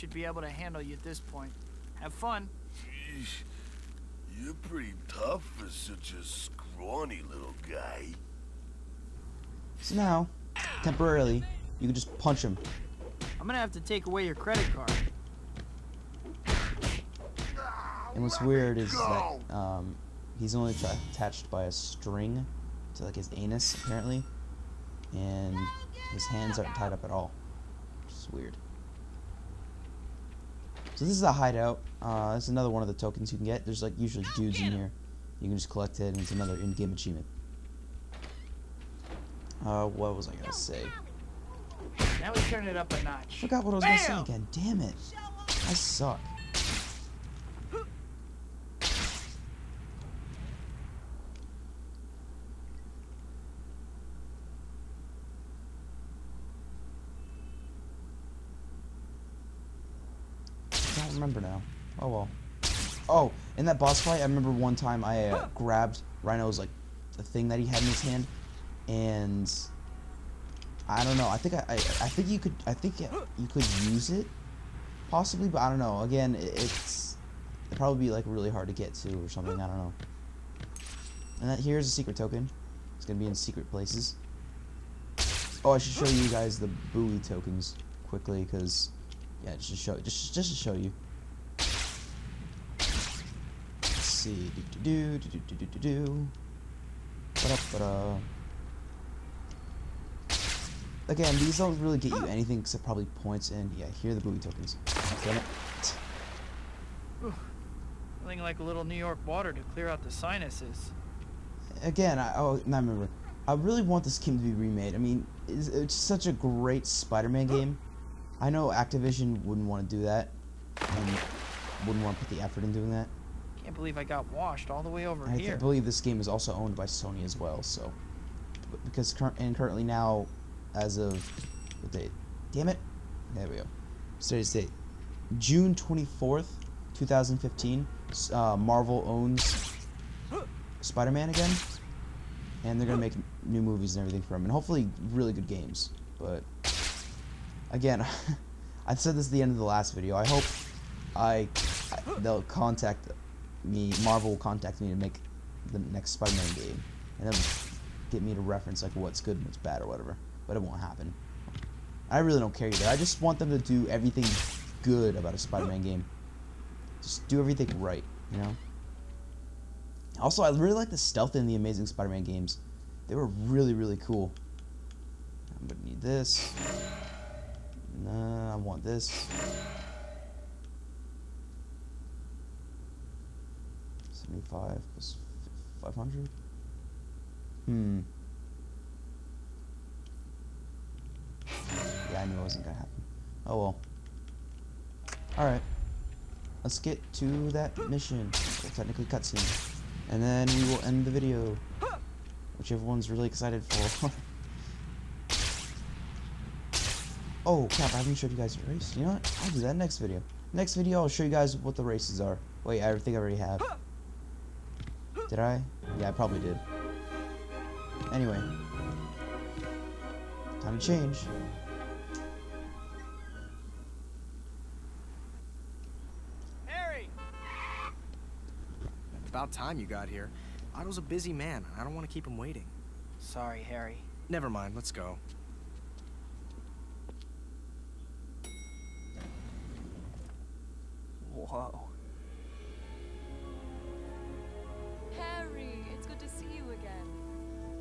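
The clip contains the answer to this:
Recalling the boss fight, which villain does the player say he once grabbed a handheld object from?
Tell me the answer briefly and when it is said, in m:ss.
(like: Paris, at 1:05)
Rhino, at 1:06.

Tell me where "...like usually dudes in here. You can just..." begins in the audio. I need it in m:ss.
0:33.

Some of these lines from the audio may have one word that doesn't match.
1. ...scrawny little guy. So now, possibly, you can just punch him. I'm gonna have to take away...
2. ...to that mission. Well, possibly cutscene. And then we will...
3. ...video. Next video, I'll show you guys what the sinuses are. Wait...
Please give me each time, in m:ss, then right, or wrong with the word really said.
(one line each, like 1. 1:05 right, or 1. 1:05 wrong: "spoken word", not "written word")
1. 0:06 wrong: "temporarily", not "possibly"
2. 3:17 wrong: "technically", not "possibly"
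3. 3:29 wrong: "races", not "sinuses".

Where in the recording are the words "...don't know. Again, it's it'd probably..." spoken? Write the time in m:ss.
1:15.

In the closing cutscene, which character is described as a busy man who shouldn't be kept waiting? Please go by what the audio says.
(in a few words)
Otto.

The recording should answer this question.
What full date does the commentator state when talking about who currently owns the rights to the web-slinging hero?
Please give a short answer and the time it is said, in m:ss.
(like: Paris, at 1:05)
June 24, 2015, at 2:15.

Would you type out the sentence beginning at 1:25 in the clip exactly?
Oh, I should show you guys the buoy tokens quickly because yeah, just to show just just to show you.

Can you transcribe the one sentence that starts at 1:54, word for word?
I mean, it's, it's such a great Spider-Man game.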